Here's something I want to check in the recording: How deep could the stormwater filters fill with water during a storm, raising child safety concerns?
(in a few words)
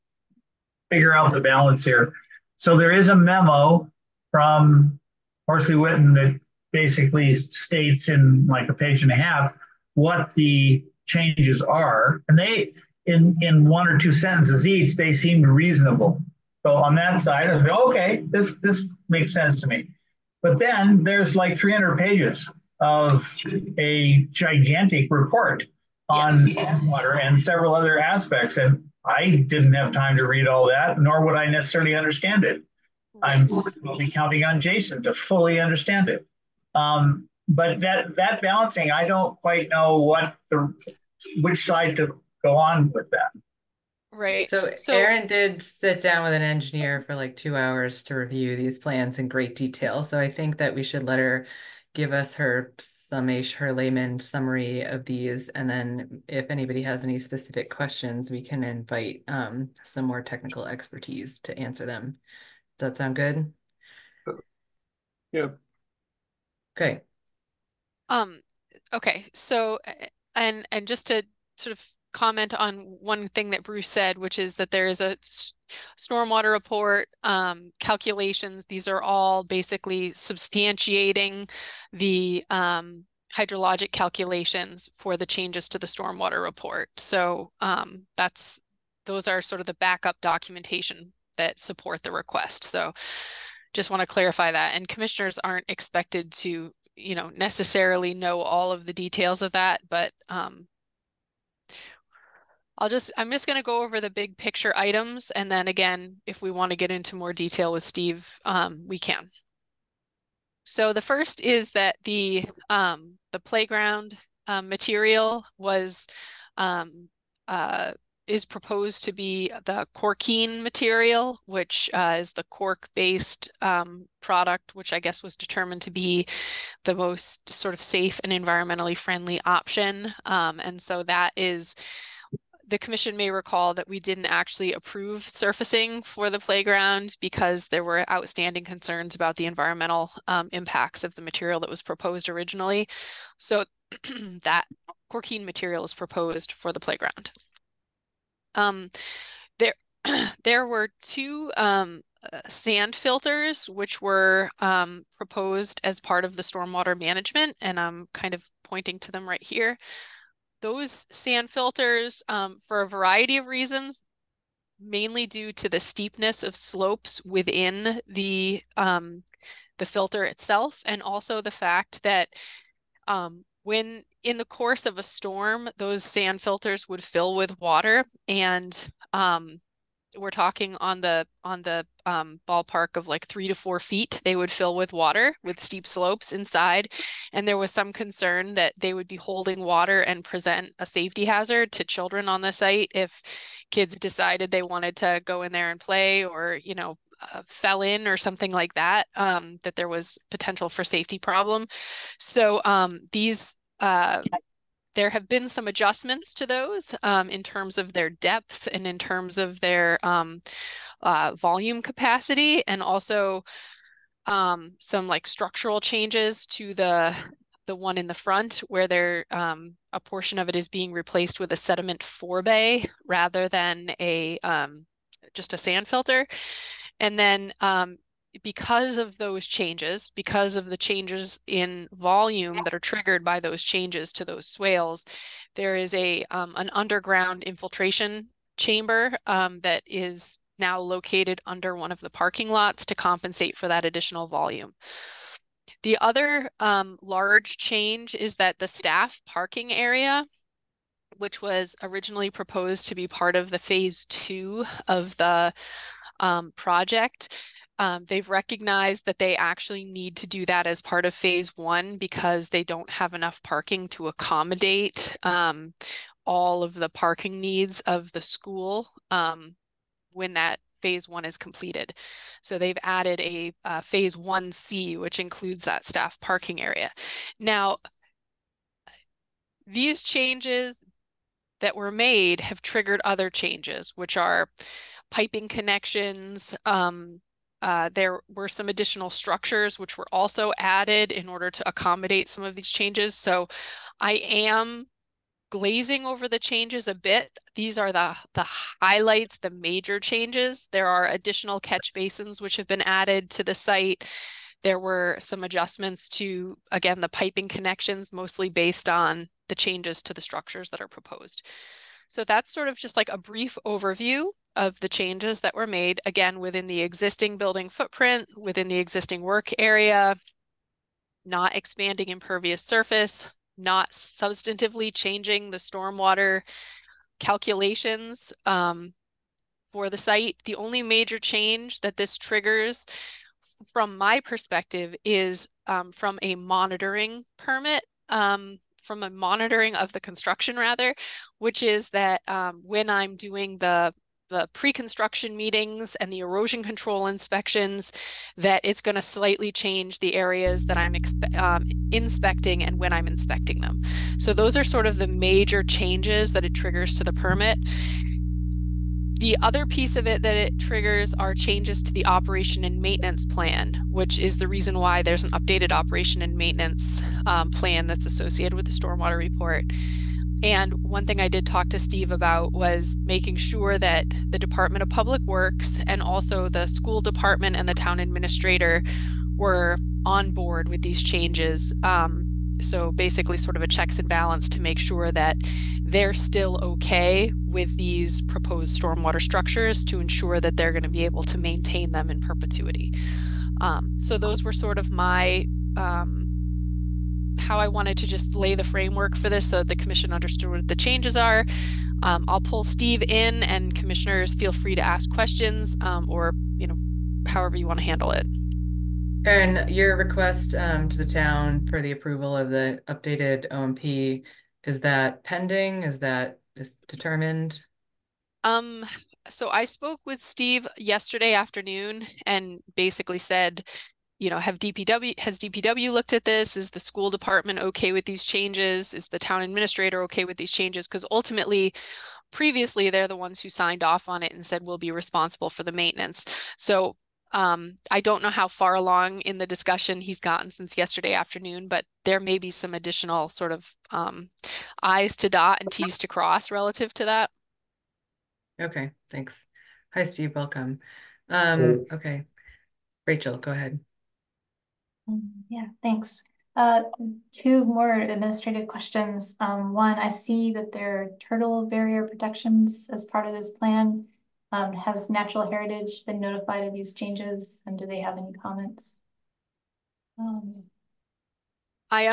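3 to 4 feet.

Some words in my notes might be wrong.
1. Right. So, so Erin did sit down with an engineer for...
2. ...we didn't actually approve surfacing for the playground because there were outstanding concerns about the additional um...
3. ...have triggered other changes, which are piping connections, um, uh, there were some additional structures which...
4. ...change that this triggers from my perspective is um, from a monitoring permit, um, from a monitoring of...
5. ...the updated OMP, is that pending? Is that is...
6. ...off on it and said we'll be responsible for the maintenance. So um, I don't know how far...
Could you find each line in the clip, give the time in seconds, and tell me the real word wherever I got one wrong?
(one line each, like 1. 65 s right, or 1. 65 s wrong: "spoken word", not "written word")
1. 44 s right
2. 133 s wrong: "environmental", not "additional"
3. 282 s right
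4. 331 s right
5. 412 s right
6. 433 s right.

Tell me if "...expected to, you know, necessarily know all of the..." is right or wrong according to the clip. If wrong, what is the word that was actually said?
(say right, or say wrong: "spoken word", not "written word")
right.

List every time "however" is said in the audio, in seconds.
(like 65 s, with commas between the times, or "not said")
407 s.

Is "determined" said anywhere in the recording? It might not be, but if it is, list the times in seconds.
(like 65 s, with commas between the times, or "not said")
125 s, 416 s.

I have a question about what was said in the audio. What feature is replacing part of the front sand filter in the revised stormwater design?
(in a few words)
sediment forebay.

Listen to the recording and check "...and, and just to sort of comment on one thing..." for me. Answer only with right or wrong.
right.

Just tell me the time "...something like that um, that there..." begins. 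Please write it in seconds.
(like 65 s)
198 s.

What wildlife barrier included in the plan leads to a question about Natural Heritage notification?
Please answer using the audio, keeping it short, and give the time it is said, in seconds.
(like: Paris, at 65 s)
turtle barrier, at 461 s.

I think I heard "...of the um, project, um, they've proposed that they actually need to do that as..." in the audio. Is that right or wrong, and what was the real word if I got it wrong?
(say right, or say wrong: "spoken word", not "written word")
wrong: "recognized", not "proposed".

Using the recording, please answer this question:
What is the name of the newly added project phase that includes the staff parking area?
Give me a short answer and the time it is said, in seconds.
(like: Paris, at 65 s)
phase 1C, at 273 s.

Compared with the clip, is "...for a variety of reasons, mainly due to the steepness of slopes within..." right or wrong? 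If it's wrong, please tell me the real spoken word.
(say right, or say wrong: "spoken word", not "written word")
right.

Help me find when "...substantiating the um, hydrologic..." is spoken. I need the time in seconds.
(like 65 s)
80 s.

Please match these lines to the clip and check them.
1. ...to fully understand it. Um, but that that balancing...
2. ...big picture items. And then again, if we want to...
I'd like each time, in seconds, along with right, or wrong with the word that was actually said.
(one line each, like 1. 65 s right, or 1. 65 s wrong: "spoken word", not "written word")
1. 35 s right
2. 104 s right.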